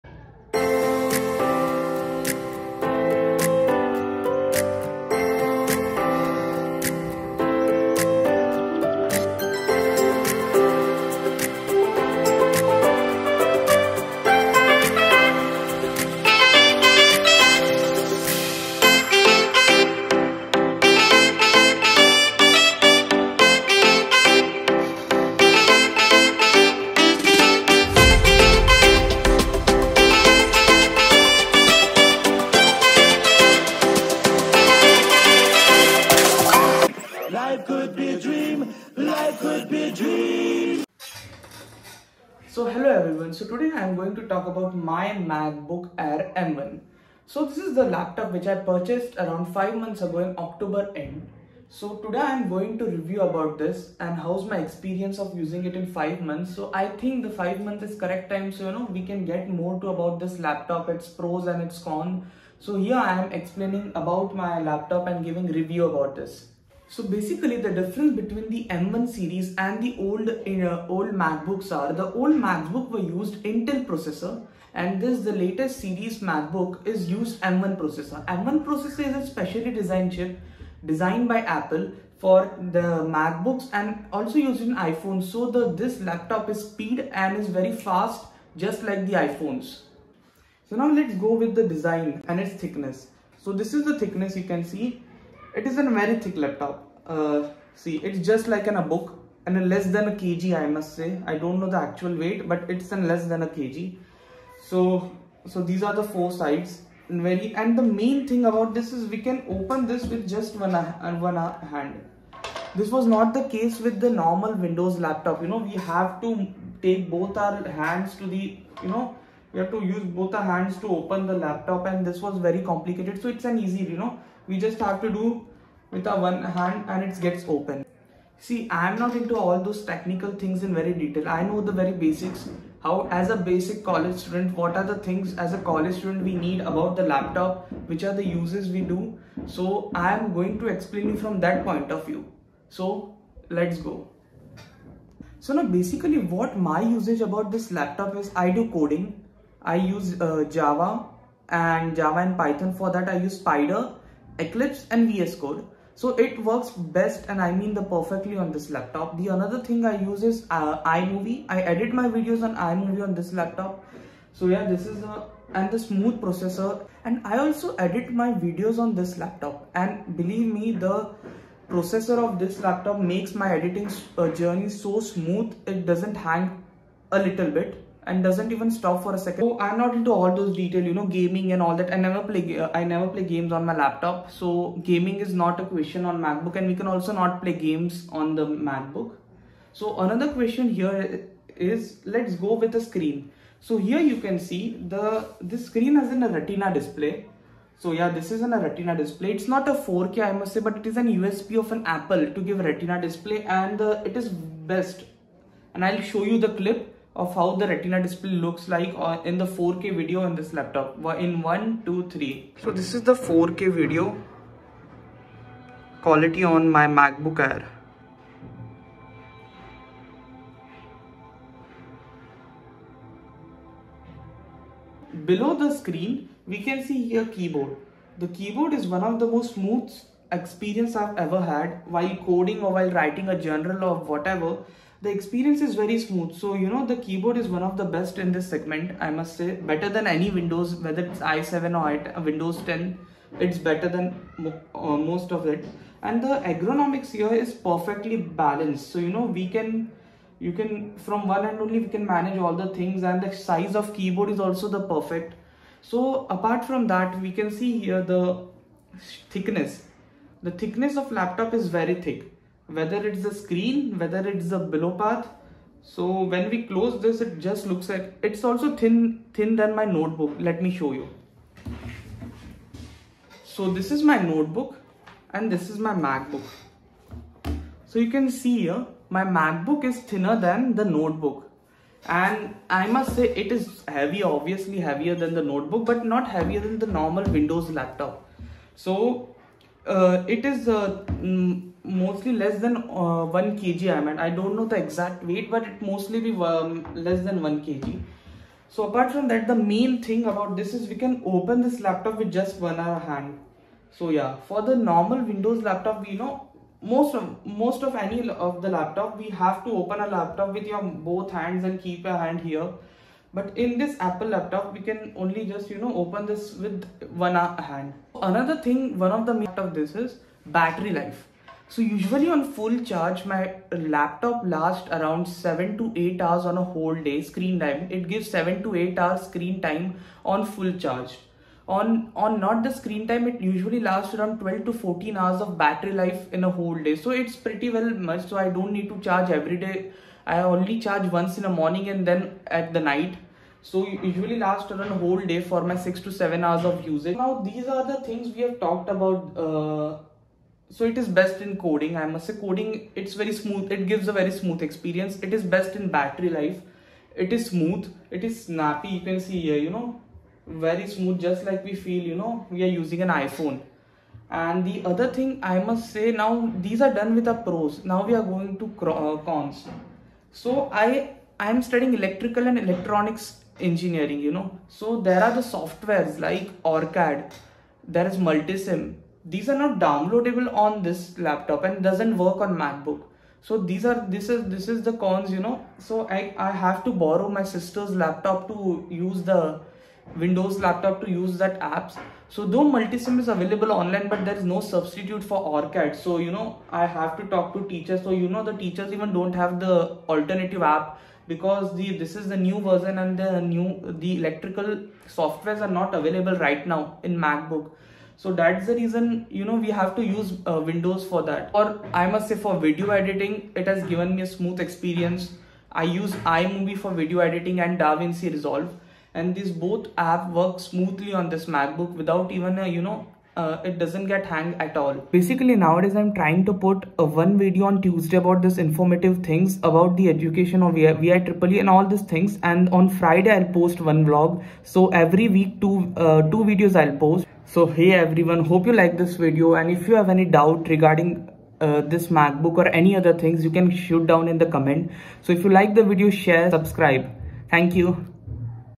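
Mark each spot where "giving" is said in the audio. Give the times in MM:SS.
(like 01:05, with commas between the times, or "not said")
01:05.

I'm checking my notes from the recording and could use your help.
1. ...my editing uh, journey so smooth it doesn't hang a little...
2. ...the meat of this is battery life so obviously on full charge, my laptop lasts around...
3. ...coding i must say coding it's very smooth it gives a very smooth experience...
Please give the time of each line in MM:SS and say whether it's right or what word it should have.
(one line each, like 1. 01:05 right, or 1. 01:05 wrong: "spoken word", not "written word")
1. 02:53 right
2. 05:19 wrong: "usually", not "obviously"
3. 05:51 right.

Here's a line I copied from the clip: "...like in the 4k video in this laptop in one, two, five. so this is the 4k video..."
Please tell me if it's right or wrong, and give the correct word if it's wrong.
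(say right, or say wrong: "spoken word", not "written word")
wrong: "three", not "five".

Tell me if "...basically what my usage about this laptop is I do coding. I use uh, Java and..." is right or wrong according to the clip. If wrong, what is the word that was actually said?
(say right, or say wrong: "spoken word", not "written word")
right.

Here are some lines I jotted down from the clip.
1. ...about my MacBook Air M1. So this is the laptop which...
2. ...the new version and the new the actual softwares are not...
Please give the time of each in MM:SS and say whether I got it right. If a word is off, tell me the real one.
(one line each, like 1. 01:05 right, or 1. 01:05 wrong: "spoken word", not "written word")
1. 00:44 right
2. 06:42 wrong: "electrical", not "actual".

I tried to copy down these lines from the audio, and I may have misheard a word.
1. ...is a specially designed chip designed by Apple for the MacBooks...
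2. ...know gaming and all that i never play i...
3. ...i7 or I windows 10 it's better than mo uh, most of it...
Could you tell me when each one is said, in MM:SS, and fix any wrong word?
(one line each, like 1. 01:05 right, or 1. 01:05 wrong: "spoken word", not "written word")
1. 01:19 right
2. 03:00 right
3. 04:01 right.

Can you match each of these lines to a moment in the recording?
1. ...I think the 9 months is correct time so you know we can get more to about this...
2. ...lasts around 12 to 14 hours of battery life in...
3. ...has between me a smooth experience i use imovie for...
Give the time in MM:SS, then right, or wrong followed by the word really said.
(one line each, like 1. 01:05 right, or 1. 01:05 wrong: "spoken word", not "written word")
1. 00:56 wrong: "5", not "9"
2. 05:33 right
3. 06:53 wrong: "given", not "between".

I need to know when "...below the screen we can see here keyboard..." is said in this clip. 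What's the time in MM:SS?
03:45.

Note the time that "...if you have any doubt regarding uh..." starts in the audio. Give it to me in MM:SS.
07:19.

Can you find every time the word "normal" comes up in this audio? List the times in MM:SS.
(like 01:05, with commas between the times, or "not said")
01:54, 04:46, 05:04.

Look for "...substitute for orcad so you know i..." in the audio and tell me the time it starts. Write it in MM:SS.
06:34.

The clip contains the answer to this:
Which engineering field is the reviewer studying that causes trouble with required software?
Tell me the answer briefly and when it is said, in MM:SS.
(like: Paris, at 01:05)
Electrical and electronics engineering, at 06:12.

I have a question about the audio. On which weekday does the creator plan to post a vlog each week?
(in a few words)
Friday.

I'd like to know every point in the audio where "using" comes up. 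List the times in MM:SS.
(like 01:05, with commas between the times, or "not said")
00:55, 06:02.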